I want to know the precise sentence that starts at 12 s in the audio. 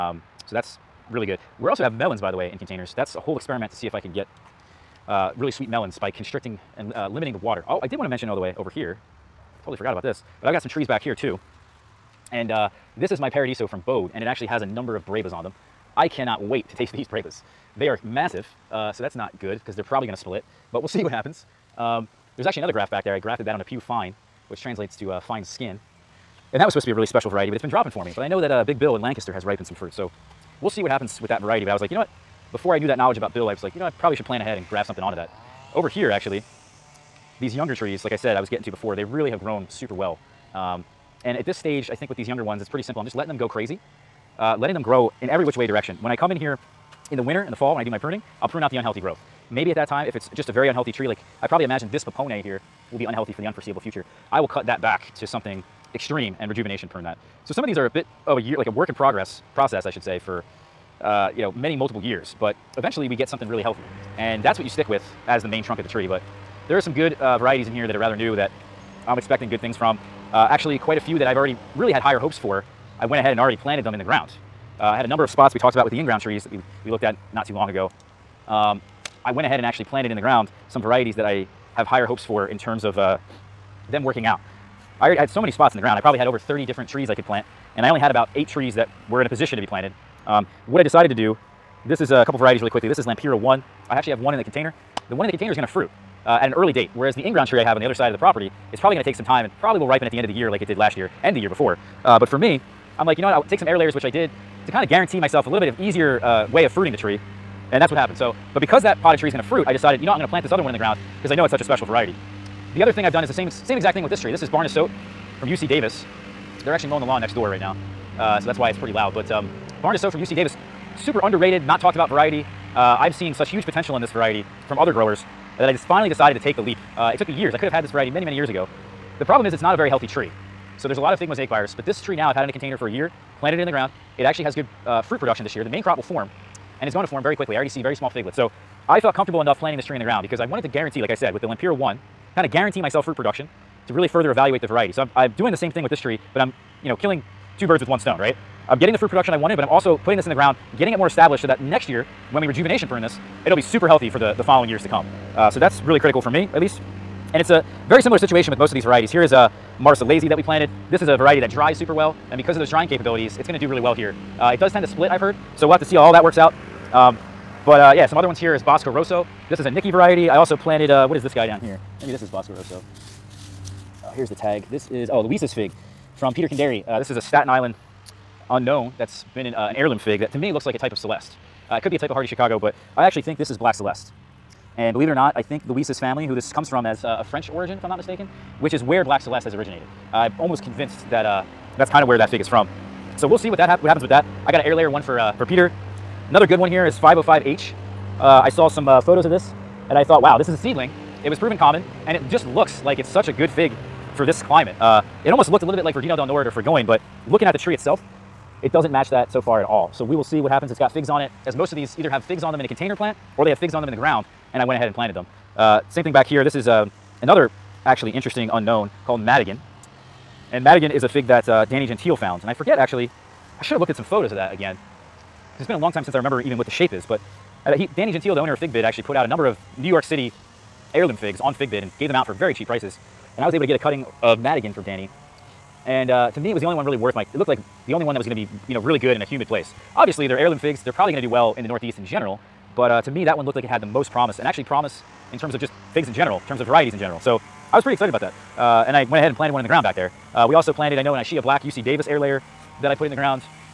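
And uh, this is my Paradiso from Bode, and it actually has a number of Brevas on them.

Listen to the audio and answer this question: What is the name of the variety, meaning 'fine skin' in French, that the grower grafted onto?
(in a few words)
Peau Fine.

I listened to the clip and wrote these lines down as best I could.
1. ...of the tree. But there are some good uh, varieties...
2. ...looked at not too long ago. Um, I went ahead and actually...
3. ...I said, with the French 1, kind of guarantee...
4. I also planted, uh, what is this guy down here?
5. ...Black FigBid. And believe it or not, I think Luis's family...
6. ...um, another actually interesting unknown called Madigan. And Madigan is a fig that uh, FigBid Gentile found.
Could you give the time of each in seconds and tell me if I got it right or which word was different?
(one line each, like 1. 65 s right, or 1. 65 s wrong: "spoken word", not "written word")
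1. 65 s right
2. 76 s right
3. 141 s wrong: "Lampira", not "French"
4. 170 s right
5. 183 s wrong: "Celeste", not "FigBid"
6. 216 s wrong: "Danny", not "FigBid".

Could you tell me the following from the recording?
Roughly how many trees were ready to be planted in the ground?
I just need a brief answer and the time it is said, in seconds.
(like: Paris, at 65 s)
8, at 88 s.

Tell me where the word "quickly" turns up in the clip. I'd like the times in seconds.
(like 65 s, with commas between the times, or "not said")
92 s, 137 s.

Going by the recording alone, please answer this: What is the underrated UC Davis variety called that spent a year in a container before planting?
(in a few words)
Barnasote.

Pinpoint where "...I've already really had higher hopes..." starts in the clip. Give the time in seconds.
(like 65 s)
71 s.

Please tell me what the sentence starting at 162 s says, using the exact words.
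And because of those drying capabilities, it's gonna do really well here.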